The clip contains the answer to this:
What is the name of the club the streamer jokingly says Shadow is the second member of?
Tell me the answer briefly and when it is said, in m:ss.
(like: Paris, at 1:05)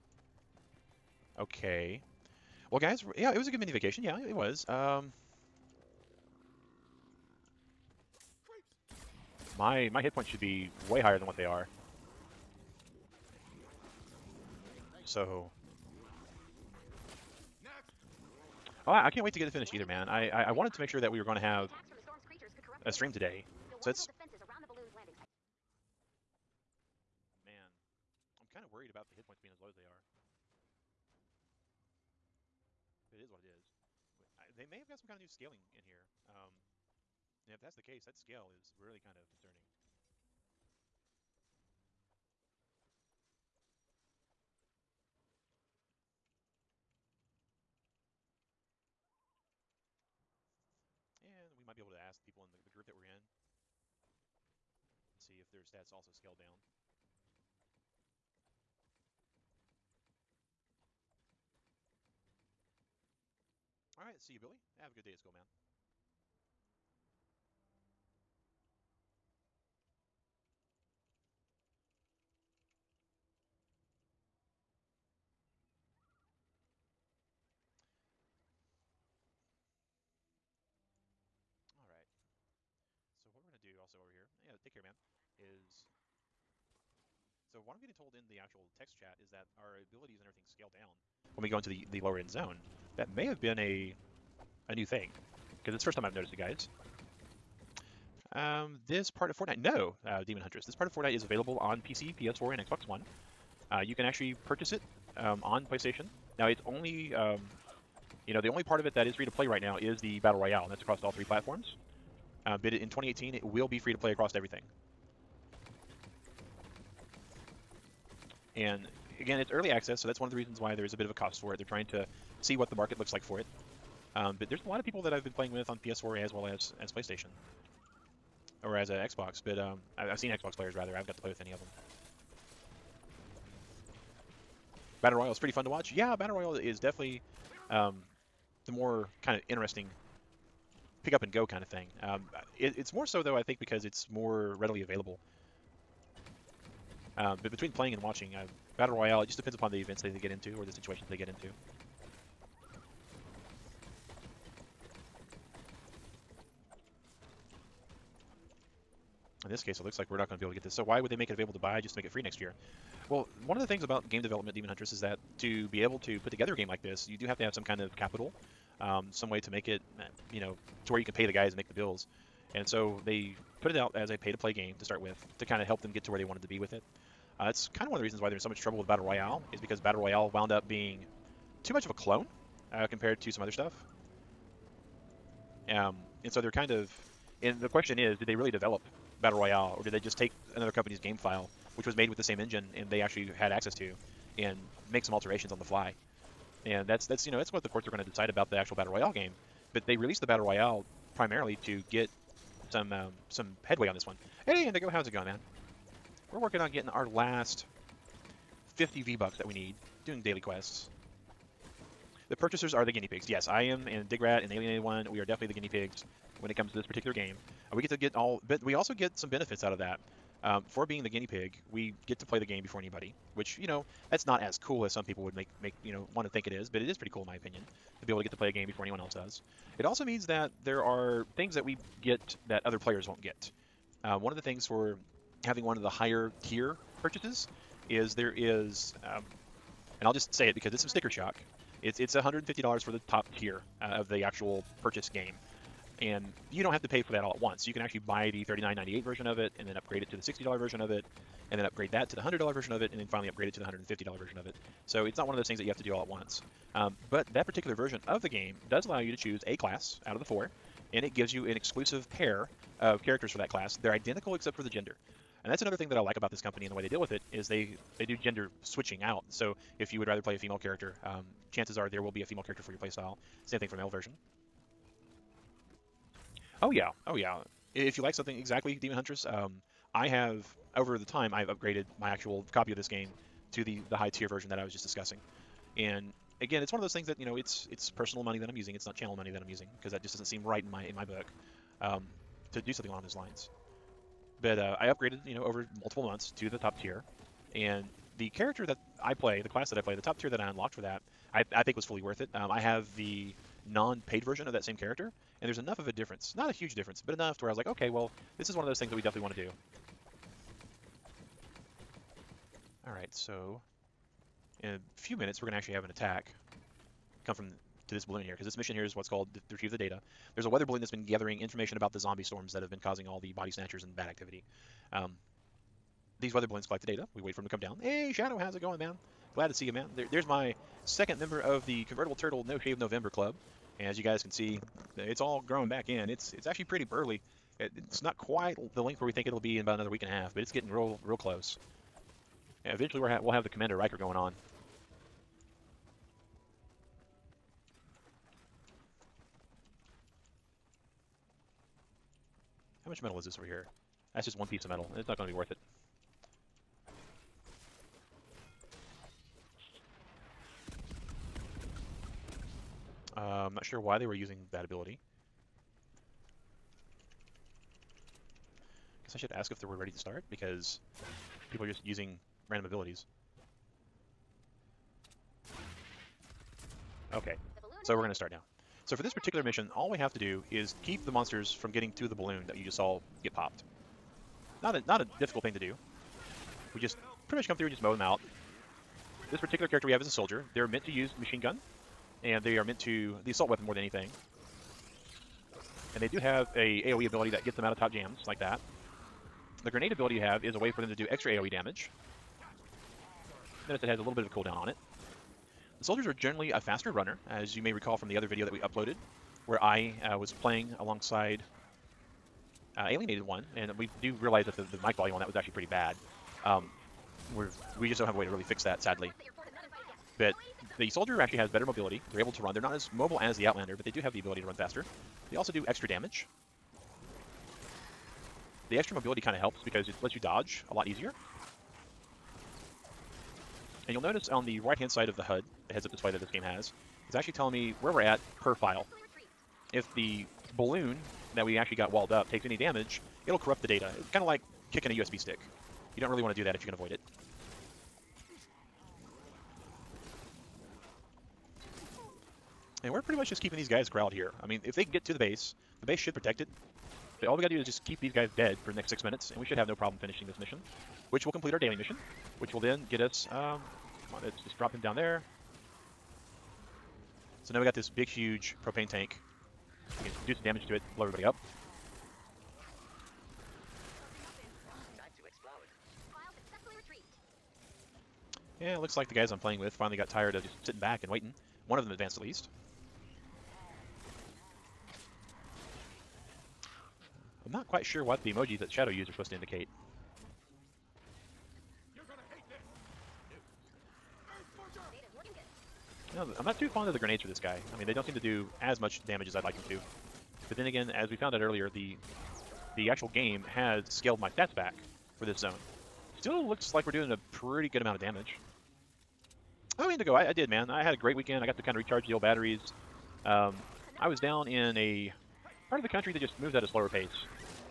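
Convertible Turtle No Shave November Club, at 5:31.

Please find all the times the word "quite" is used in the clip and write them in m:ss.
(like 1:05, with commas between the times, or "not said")
5:38, 8:07.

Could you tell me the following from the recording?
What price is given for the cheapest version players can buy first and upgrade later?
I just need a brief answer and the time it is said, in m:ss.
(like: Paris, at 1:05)
$39.98, at 4:08.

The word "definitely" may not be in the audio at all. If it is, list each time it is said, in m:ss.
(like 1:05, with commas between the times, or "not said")
2:16, 3:35, 5:09.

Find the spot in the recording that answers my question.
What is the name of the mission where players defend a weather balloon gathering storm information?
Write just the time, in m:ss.
5:19.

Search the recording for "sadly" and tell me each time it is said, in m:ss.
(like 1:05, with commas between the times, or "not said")
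6:58.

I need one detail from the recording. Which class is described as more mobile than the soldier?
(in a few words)
Outlander.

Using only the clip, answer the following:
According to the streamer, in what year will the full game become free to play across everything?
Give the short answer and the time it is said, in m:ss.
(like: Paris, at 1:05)
2018, at 1:52.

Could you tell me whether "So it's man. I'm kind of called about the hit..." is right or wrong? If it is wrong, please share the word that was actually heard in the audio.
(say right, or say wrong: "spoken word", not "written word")
wrong: "worried", not "called".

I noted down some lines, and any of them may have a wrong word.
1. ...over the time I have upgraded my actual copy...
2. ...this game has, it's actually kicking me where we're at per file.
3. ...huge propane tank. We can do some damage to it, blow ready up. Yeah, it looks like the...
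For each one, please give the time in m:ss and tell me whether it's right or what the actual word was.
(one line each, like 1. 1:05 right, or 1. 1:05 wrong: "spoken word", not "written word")
1. 4:40 right
2. 7:16 wrong: "telling", not "kicking"
3. 7:48 wrong: "everybody", not "ready".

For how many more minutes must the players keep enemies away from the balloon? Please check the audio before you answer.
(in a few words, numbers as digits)
6.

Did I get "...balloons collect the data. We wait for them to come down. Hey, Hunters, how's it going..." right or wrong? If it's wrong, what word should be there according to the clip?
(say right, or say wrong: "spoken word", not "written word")
wrong: "Shadow", not "Hunters".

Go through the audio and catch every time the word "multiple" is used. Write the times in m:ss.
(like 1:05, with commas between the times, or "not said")
4:55.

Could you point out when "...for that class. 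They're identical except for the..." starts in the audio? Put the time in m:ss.
4:23.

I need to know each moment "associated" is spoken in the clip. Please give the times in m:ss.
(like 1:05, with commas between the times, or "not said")
not said.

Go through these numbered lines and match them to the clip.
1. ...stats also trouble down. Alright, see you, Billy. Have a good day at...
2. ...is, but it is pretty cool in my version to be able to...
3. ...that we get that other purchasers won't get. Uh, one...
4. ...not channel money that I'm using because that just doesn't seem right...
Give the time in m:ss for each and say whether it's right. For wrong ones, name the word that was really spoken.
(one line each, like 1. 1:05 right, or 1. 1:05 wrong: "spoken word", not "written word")
1. 0:55 wrong: "scale", not "trouble"
2. 3:46 wrong: "opinion", not "version"
3. 3:51 wrong: "players", not "purchasers"
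4. 4:48 right.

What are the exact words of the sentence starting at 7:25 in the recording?
You don't really want to do that if you can avoid it.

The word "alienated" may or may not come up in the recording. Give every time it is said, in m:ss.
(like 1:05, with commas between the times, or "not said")
3:34, 6:52.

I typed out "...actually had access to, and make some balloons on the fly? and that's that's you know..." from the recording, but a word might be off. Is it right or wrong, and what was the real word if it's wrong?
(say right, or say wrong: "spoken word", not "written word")
wrong: "alterations", not "balloons".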